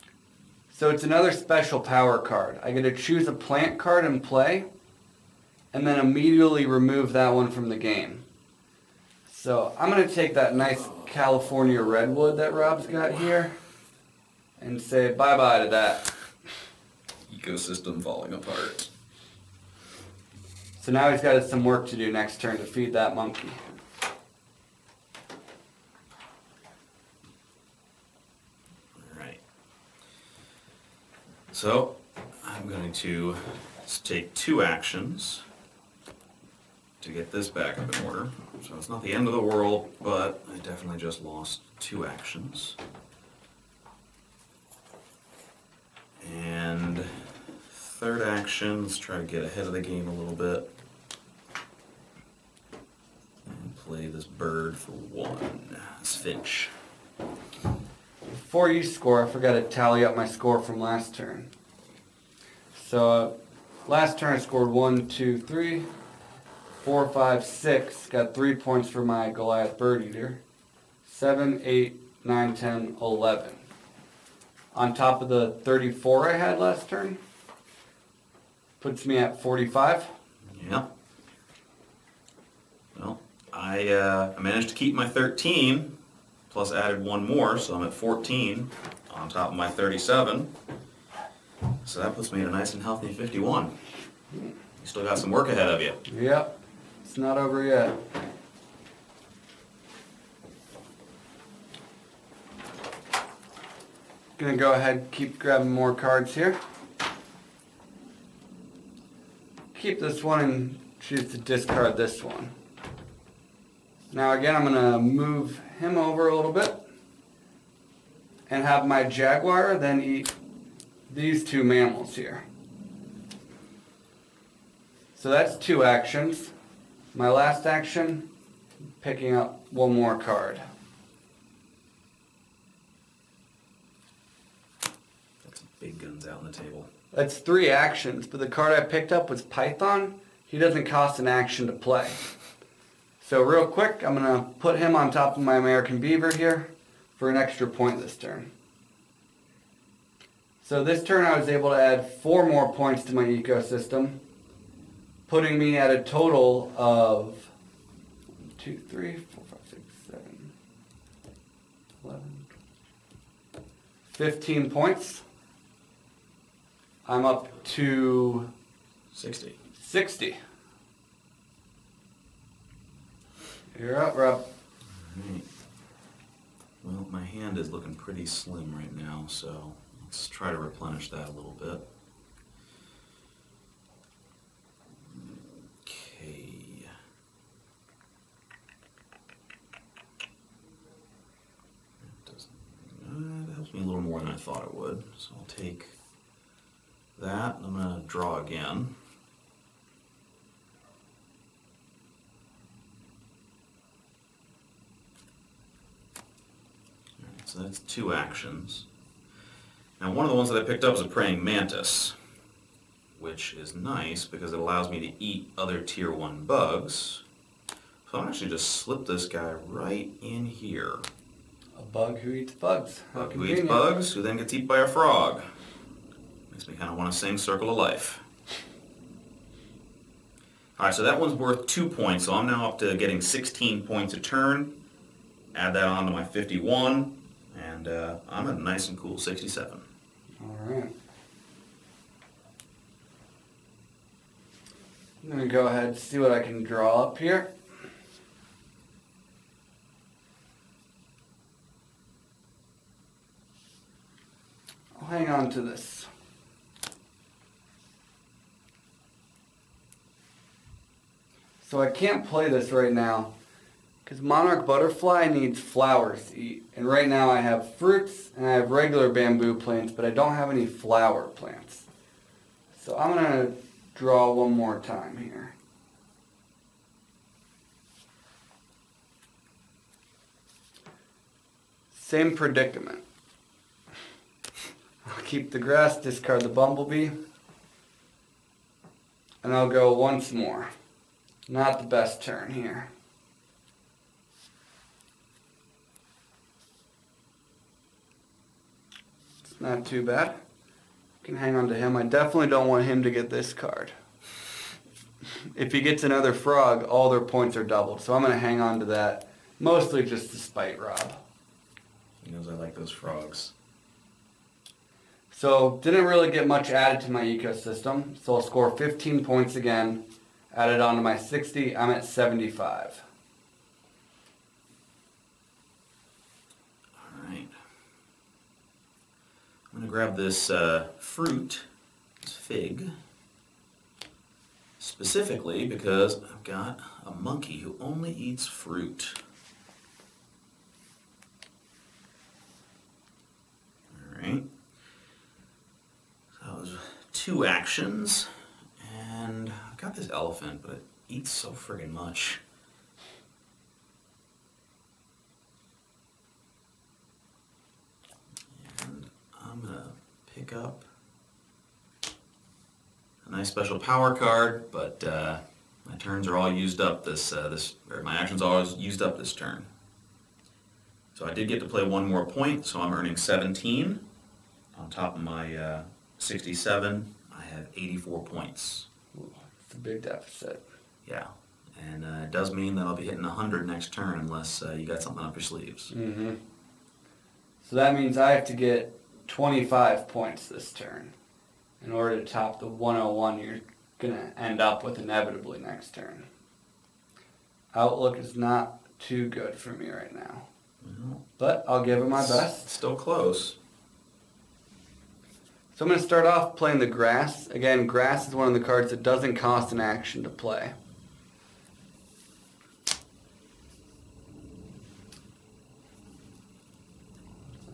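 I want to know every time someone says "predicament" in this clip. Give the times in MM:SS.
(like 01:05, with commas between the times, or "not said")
04:42.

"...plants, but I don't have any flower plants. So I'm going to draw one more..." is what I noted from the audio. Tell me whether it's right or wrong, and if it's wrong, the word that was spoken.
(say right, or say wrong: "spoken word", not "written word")
right.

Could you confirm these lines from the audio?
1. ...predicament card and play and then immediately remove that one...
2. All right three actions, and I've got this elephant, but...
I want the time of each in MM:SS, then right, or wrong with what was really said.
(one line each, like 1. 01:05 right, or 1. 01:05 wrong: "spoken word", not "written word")
1. 00:03 wrong: "plant", not "predicament"
2. 05:44 wrong: "two", not "three".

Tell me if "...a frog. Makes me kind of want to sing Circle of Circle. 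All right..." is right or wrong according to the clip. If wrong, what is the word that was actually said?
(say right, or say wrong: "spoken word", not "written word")
wrong: "Life", not "Circle".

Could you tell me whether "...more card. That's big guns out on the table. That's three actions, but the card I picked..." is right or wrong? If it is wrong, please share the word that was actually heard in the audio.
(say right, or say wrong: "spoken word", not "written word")
right.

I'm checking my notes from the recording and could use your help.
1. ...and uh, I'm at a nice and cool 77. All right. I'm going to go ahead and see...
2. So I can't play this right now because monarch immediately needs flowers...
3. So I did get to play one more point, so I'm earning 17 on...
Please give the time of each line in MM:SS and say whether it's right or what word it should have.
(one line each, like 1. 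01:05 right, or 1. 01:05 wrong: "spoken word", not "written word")
1. 03:57 wrong: "67", not "77"
2. 04:21 wrong: "butterfly", not "immediately"
3. 06:11 right.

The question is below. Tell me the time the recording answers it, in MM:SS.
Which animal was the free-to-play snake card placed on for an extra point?
02:25.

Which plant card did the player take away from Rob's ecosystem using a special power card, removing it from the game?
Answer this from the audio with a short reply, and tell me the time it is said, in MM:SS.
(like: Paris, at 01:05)
California redwood, at 00:11.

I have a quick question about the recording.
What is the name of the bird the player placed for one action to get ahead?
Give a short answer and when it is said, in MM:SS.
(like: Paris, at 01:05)
Finch, at 00:56.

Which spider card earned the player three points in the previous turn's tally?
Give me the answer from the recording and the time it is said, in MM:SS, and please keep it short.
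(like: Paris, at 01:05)
Goliath bird eater, at 01:09.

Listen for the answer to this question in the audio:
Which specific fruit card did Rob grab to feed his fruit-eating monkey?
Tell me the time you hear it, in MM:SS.
05:32.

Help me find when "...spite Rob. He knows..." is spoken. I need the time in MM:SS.
05:10.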